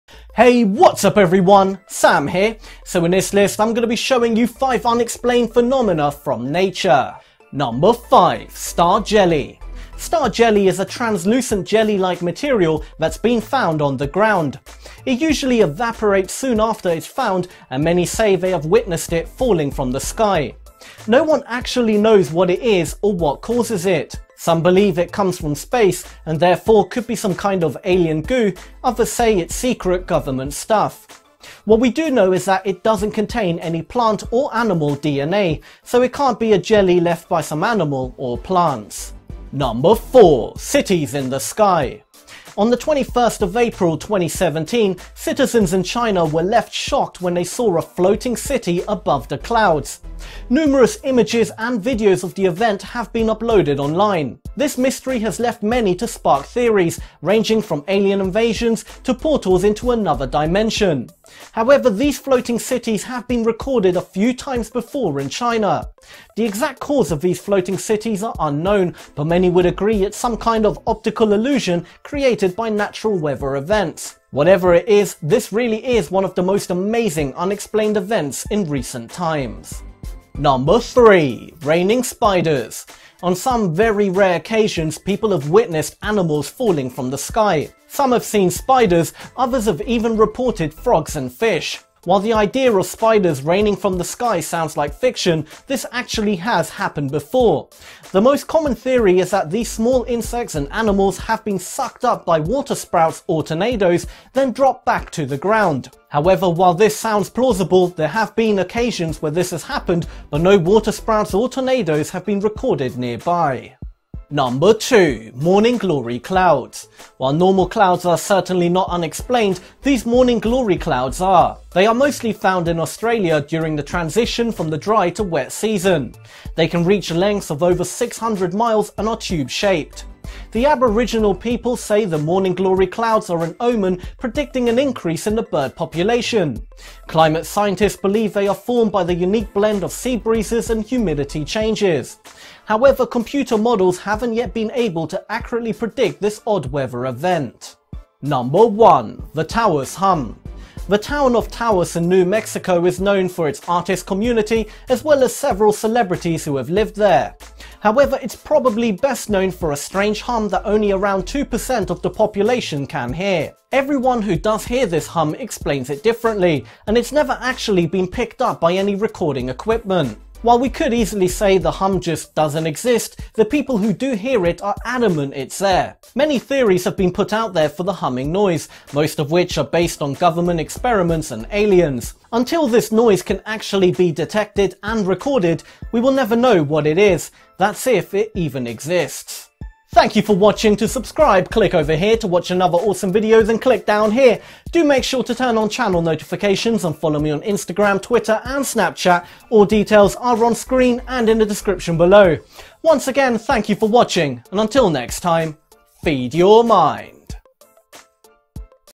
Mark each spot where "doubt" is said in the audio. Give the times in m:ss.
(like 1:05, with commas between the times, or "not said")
not said.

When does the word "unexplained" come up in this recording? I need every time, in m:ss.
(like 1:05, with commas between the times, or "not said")
0:04, 1:17, 1:58.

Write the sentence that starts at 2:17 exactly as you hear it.
Climate scientists believe they are formed by the unique blend of sea breezes and humidity changes.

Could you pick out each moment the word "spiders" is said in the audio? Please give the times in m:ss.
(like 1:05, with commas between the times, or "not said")
1:22, 1:28, 1:32.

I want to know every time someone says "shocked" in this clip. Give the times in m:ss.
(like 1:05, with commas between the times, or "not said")
0:46.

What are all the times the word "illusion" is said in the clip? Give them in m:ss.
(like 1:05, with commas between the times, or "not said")
1:11.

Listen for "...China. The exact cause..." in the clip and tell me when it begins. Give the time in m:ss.
1:05.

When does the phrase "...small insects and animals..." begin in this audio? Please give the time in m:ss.
1:39.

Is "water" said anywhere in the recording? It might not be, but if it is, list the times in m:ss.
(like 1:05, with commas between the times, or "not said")
1:42, 1:50.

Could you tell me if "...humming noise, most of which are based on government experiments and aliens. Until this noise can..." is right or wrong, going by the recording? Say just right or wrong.
right.